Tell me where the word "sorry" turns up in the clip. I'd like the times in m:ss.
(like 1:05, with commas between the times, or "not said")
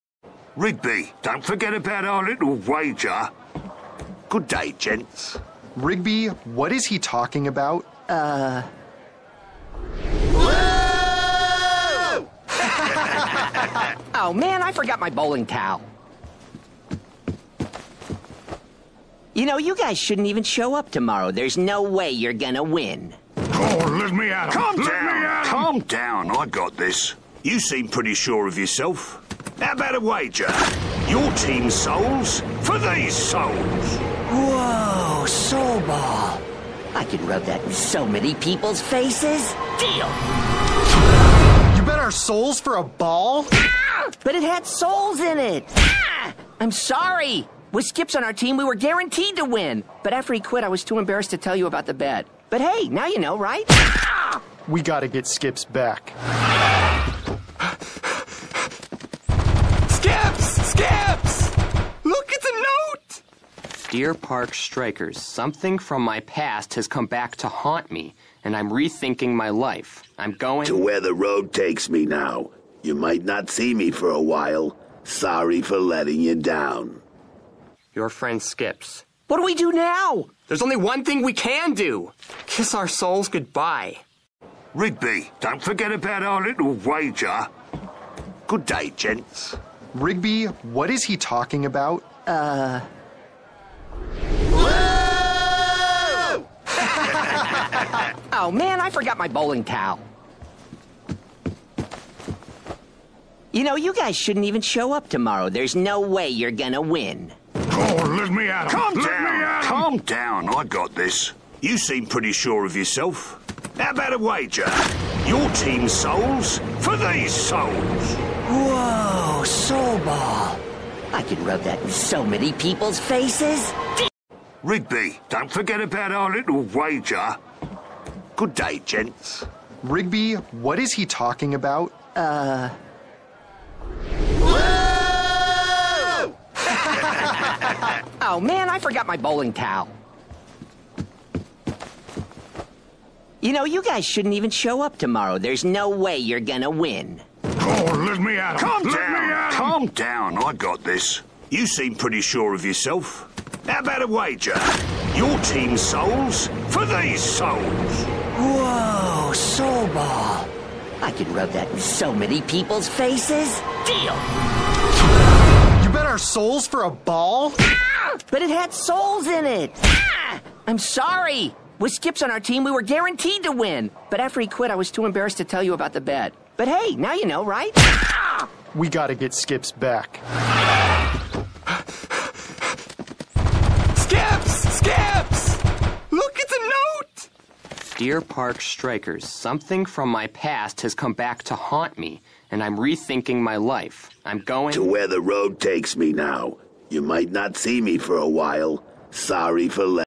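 0:46, 1:15, 2:50, 3:19.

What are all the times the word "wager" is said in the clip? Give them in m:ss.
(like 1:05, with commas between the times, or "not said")
0:02, 0:29, 1:26, 1:54, 2:06, 2:34.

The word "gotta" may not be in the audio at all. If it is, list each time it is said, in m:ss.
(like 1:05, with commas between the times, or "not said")
0:54, 2:58.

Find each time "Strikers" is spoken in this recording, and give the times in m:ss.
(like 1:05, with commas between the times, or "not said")
1:04, 3:08.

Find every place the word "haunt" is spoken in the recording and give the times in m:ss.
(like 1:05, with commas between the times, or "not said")
1:07, 3:11.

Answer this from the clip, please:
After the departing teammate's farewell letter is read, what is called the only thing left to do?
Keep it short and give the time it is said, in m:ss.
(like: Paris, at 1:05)
Kiss our souls goodbye, at 1:22.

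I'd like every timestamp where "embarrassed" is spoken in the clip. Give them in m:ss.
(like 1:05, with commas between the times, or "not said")
0:50, 2:55.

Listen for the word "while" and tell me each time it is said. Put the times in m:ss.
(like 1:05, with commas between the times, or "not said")
1:14, 3:18.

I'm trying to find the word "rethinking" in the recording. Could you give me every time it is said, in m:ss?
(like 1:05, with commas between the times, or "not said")
1:08, 3:12.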